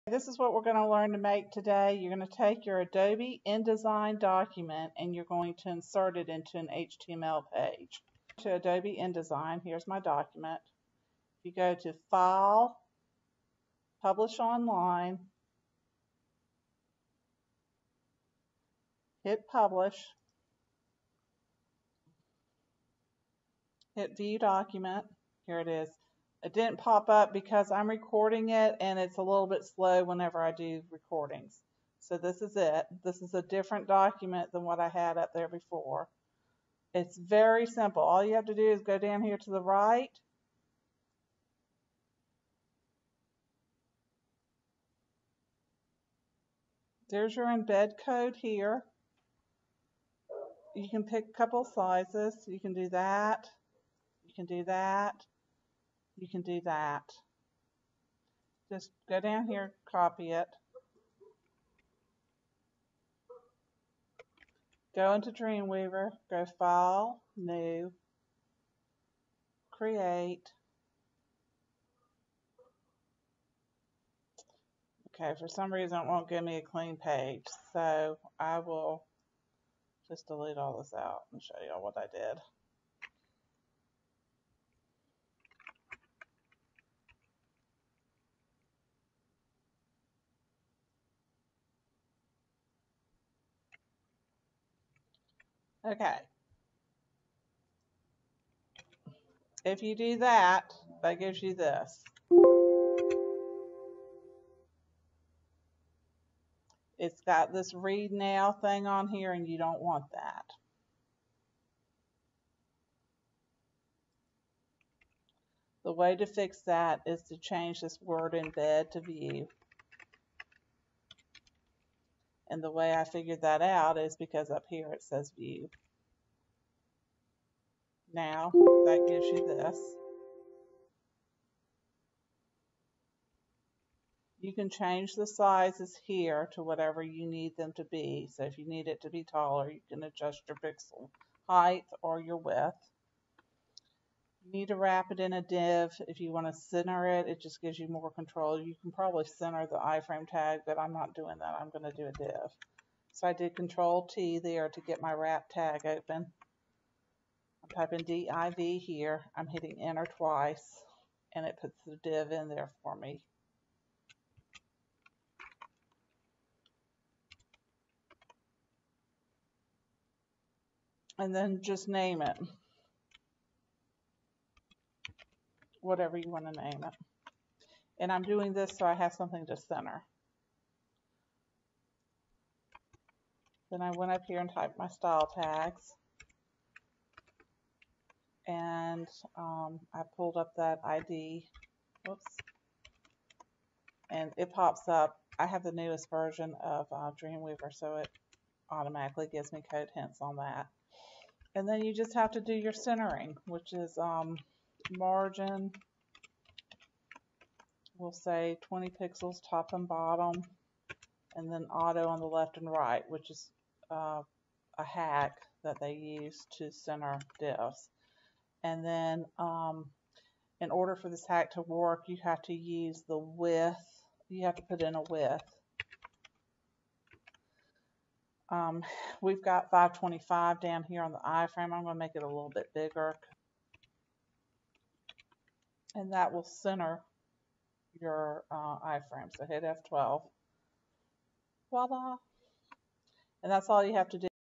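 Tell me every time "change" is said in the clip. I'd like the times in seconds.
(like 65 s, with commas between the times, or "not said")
117 s, 134 s.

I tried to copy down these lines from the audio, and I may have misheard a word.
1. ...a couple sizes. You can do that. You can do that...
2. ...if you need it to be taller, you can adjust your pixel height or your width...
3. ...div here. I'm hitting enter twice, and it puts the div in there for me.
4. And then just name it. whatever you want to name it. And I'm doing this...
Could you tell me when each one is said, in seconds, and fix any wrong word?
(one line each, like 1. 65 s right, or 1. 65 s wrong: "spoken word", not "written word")
1. 51 s right
2. 138 s right
3. 158 s right
4. 171 s right.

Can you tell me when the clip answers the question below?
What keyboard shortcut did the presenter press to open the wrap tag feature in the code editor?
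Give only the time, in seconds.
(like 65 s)
153 s.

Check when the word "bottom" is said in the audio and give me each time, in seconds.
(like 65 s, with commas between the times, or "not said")
209 s.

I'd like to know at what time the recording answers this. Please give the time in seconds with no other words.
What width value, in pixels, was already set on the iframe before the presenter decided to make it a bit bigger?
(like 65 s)
229 s.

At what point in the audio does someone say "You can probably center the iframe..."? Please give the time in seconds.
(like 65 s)
148 s.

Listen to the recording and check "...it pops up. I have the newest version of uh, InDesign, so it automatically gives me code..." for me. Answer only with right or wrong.
wrong.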